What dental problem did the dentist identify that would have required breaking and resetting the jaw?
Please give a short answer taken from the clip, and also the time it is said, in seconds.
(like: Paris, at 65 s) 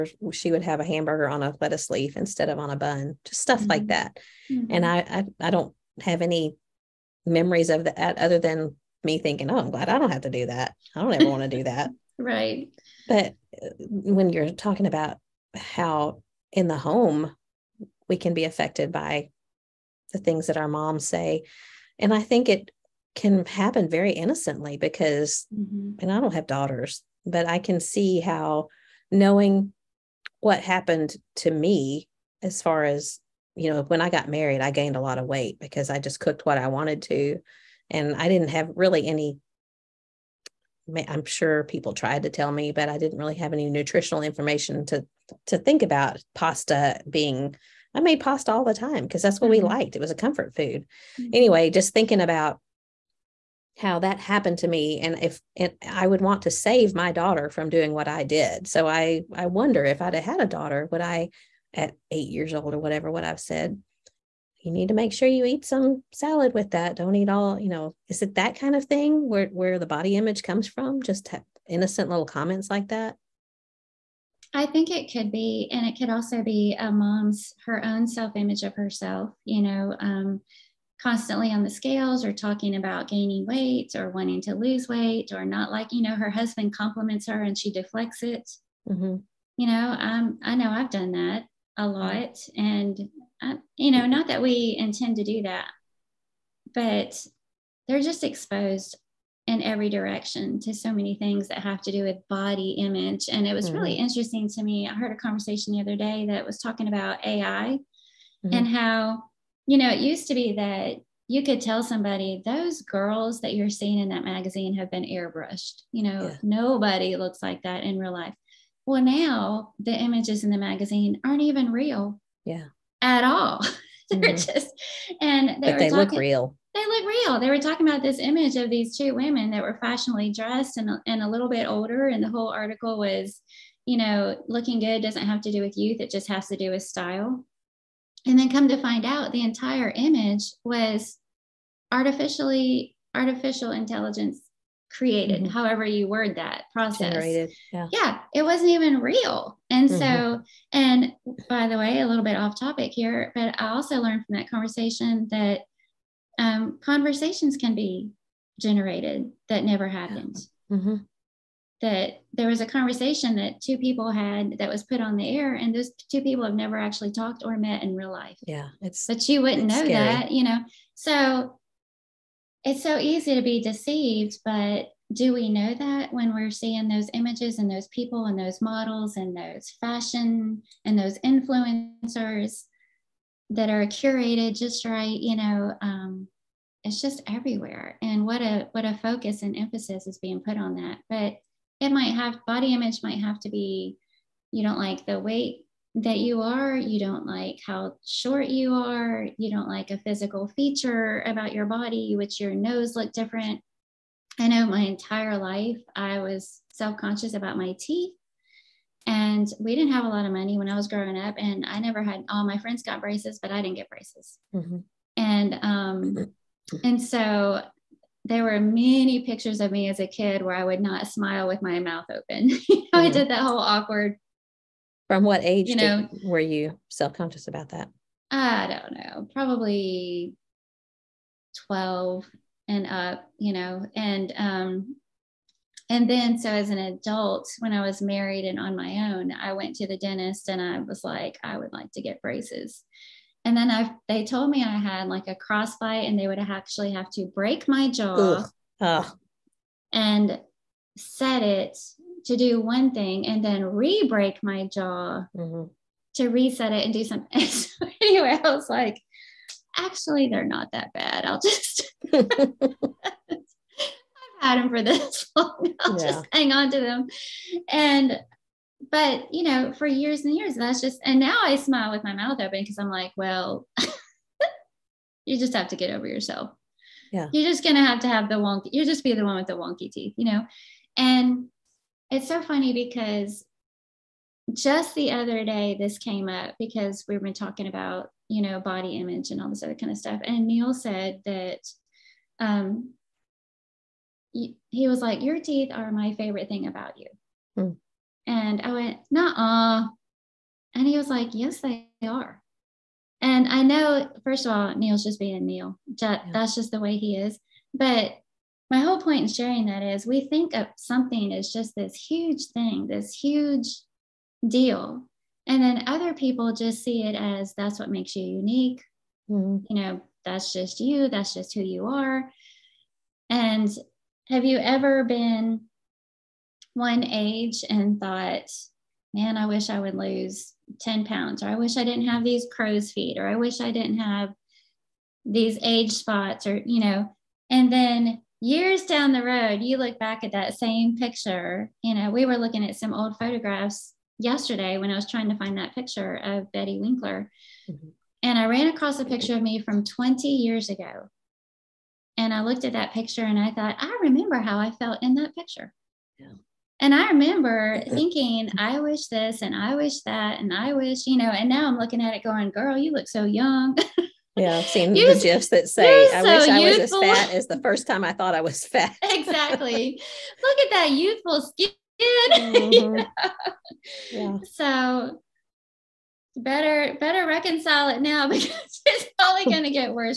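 crossbite, at 245 s.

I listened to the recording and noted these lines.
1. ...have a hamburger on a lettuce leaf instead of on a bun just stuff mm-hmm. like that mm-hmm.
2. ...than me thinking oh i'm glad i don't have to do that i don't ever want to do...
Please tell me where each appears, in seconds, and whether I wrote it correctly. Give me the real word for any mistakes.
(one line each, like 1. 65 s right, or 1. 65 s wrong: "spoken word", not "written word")
1. 0 s right
2. 8 s right.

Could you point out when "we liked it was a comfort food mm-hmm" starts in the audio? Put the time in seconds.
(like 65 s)
49 s.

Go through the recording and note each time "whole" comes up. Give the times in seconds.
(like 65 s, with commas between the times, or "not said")
132 s, 223 s, 308 s.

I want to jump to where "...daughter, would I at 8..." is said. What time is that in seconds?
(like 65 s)
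60 s.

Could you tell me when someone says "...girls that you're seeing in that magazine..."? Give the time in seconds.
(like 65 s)
112 s.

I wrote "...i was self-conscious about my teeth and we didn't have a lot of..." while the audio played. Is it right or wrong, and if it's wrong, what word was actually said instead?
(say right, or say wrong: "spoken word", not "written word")
right.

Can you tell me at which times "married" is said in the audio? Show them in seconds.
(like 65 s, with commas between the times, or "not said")
34 s, 237 s.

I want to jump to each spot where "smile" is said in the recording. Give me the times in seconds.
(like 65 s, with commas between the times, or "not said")
221 s, 271 s.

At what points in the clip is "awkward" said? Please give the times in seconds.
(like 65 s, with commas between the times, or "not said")
223 s.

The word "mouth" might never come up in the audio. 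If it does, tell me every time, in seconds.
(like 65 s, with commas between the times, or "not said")
221 s, 272 s.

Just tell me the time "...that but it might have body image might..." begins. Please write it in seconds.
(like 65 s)
190 s.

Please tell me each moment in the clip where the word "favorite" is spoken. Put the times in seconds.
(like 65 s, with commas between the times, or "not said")
296 s.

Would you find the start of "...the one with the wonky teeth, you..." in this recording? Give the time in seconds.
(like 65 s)
279 s.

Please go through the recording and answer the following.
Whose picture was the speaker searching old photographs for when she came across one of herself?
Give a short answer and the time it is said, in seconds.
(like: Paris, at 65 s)
Betty Winkler, at 346 s.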